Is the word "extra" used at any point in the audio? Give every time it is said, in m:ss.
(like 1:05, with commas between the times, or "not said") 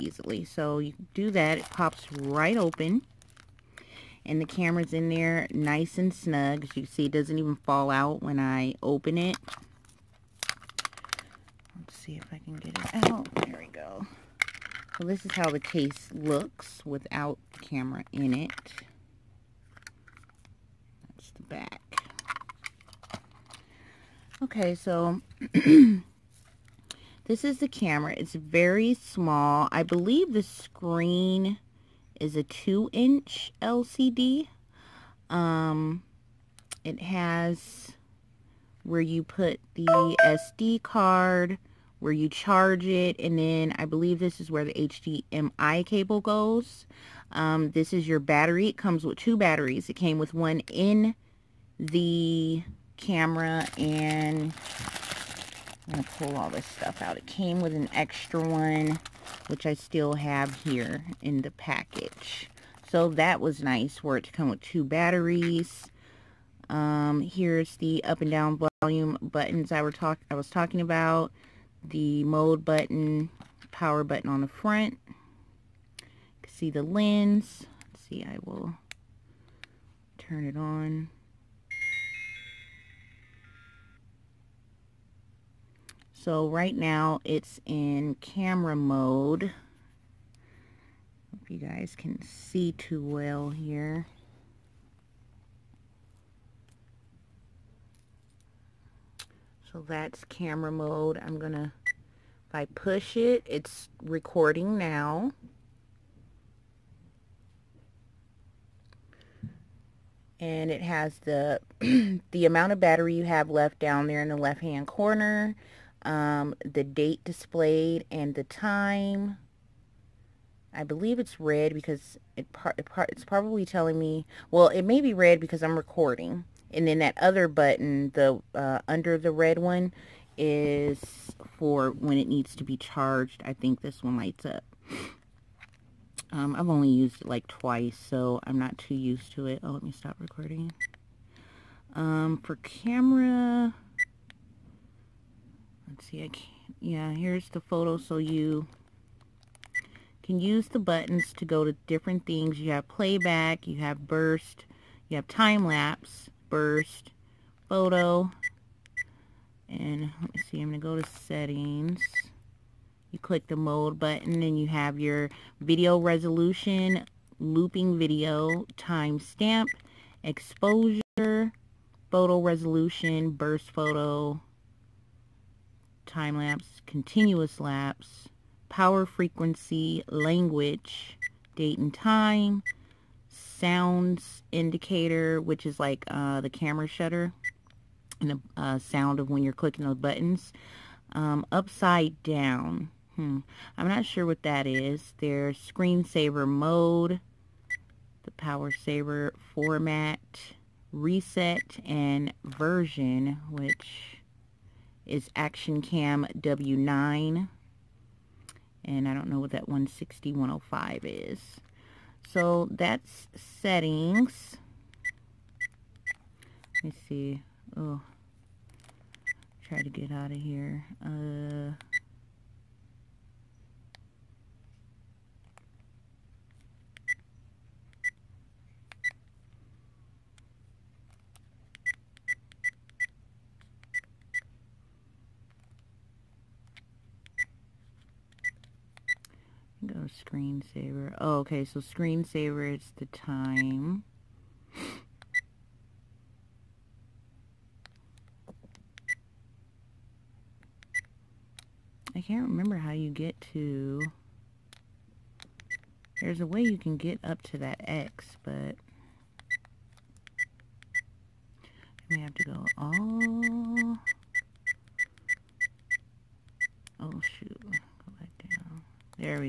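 0:57.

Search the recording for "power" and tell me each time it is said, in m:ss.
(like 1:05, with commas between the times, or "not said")
1:13, 2:58, 3:18.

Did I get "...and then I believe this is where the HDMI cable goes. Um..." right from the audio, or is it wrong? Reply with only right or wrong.
right.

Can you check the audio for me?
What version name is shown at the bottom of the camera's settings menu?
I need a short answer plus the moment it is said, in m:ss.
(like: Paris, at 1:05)
Action Cam W9, at 3:25.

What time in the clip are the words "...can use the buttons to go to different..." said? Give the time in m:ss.
2:30.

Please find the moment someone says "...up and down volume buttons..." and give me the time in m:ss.
1:08.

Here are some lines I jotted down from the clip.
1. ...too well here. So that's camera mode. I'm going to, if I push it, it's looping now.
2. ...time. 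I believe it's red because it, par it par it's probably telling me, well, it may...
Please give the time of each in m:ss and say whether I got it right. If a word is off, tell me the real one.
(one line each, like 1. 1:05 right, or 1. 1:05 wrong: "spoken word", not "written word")
1. 1:32 wrong: "recording", not "looping"
2. 1:58 right.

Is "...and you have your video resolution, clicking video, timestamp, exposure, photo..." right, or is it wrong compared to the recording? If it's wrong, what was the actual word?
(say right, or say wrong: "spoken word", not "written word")
wrong: "looping", not "clicking".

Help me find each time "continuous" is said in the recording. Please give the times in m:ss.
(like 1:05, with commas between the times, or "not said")
2:56.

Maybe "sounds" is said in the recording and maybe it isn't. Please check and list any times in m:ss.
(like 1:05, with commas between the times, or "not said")
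3:03, 3:08.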